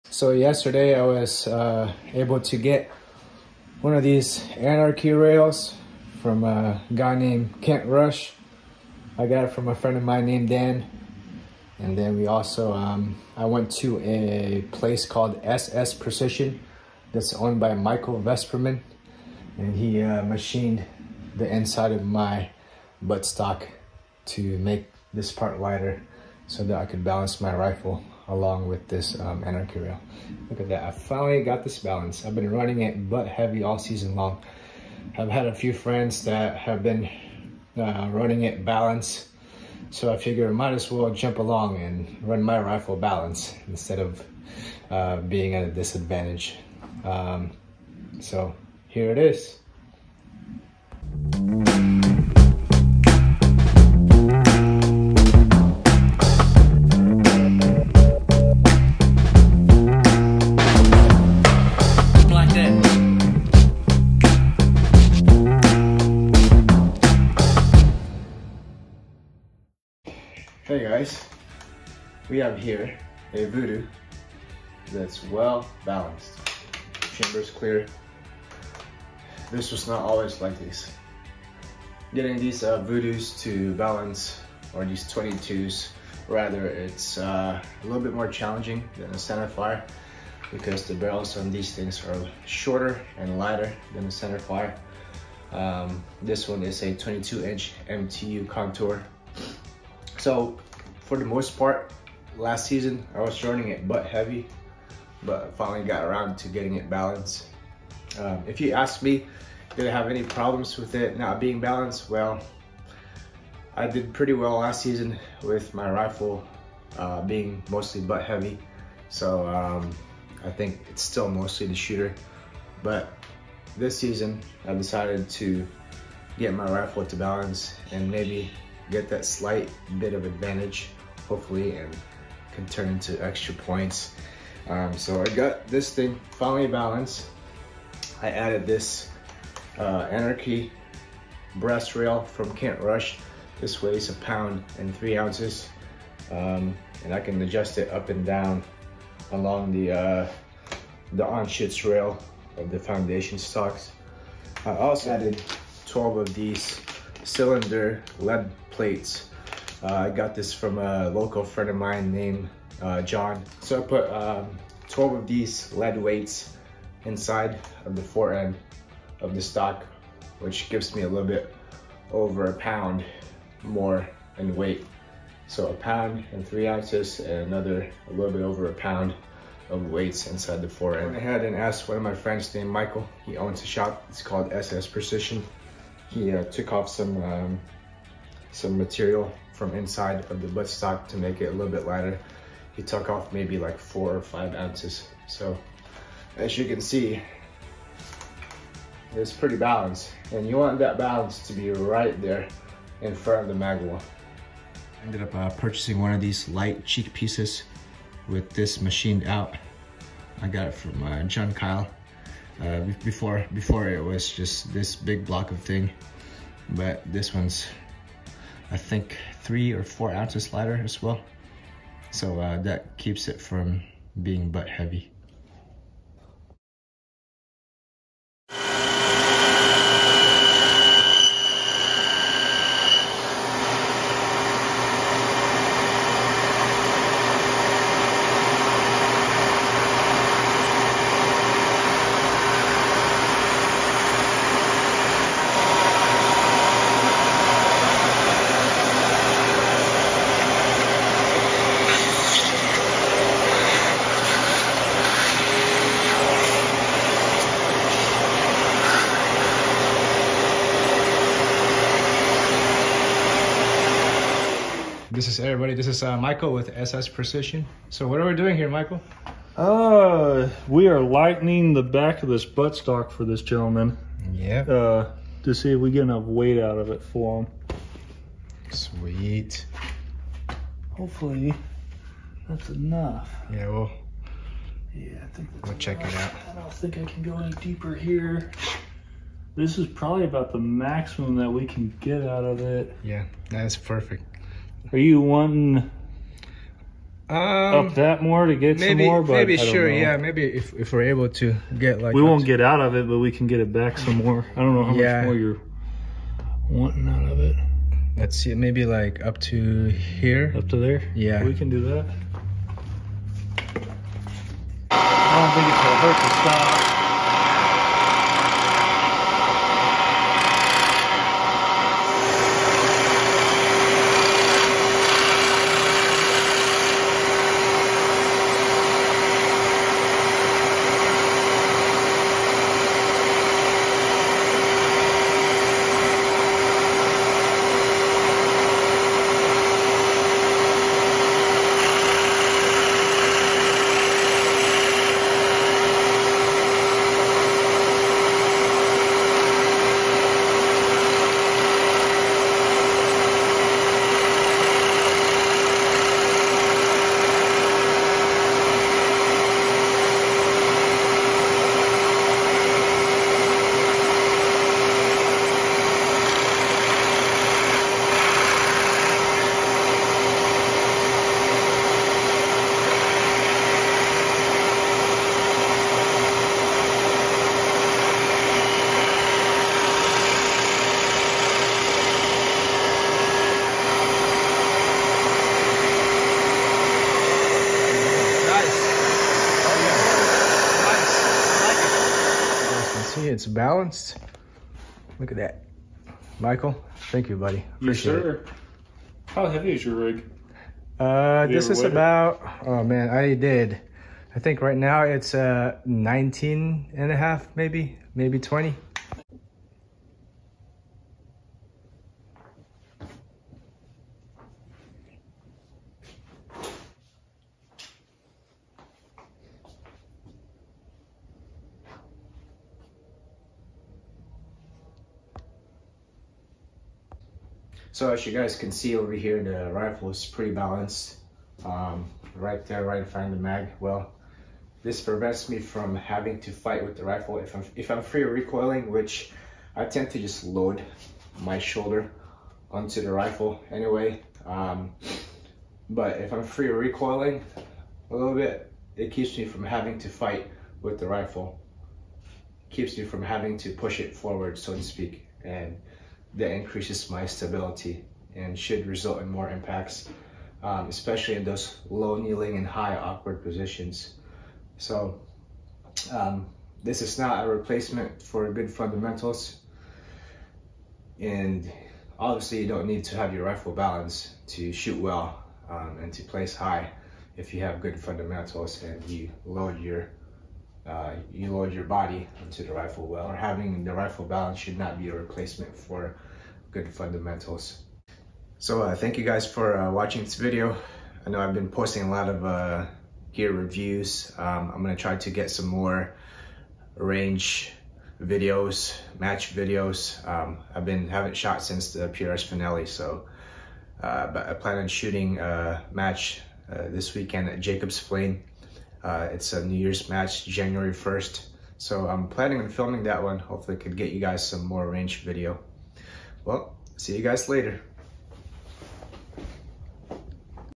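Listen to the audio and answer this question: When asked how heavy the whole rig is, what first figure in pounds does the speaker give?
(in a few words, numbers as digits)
19.5.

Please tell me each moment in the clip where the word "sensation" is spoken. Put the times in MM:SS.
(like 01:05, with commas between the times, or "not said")
not said.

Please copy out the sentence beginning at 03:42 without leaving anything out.
So uh, that keeps it from being butt heavy.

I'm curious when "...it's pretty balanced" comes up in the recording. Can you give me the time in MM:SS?
03:19.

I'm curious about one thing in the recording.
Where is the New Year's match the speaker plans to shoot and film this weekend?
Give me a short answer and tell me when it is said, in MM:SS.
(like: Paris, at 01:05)
Jacob's Plain, at 08:27.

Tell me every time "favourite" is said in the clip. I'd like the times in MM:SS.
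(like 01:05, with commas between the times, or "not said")
not said.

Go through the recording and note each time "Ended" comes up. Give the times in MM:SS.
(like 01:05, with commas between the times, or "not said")
03:25.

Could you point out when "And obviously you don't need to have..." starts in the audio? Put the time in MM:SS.
07:51.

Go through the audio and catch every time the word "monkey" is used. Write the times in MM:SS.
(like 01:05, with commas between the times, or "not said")
not said.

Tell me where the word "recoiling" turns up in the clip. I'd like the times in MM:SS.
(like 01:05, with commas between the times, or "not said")
07:18, 07:26.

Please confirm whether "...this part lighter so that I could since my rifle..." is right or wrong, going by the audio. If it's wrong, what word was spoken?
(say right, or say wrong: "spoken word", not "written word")
wrong: "balance", not "since".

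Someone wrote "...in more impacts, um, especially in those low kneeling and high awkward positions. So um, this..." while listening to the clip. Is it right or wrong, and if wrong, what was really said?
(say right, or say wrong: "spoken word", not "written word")
right.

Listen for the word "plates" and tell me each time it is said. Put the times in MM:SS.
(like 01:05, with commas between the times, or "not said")
02:38.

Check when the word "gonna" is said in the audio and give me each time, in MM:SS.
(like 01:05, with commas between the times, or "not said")
05:15, 08:14.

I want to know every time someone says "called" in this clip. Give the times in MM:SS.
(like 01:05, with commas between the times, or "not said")
00:15, 03:04.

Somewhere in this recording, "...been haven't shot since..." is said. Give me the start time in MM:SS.
08:20.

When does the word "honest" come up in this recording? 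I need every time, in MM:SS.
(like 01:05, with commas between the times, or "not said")
not said.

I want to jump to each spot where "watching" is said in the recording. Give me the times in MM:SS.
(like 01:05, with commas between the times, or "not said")
08:09.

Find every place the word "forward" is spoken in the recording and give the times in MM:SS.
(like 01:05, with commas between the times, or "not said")
07:34.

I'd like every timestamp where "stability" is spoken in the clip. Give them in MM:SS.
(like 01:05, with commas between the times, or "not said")
07:37.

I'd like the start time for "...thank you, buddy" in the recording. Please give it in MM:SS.
06:37.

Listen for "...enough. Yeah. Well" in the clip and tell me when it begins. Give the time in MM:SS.
04:42.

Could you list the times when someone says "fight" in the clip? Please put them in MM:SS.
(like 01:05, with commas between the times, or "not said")
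07:16, 07:30.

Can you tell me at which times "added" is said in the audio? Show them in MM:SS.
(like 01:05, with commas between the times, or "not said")
02:18, 02:35.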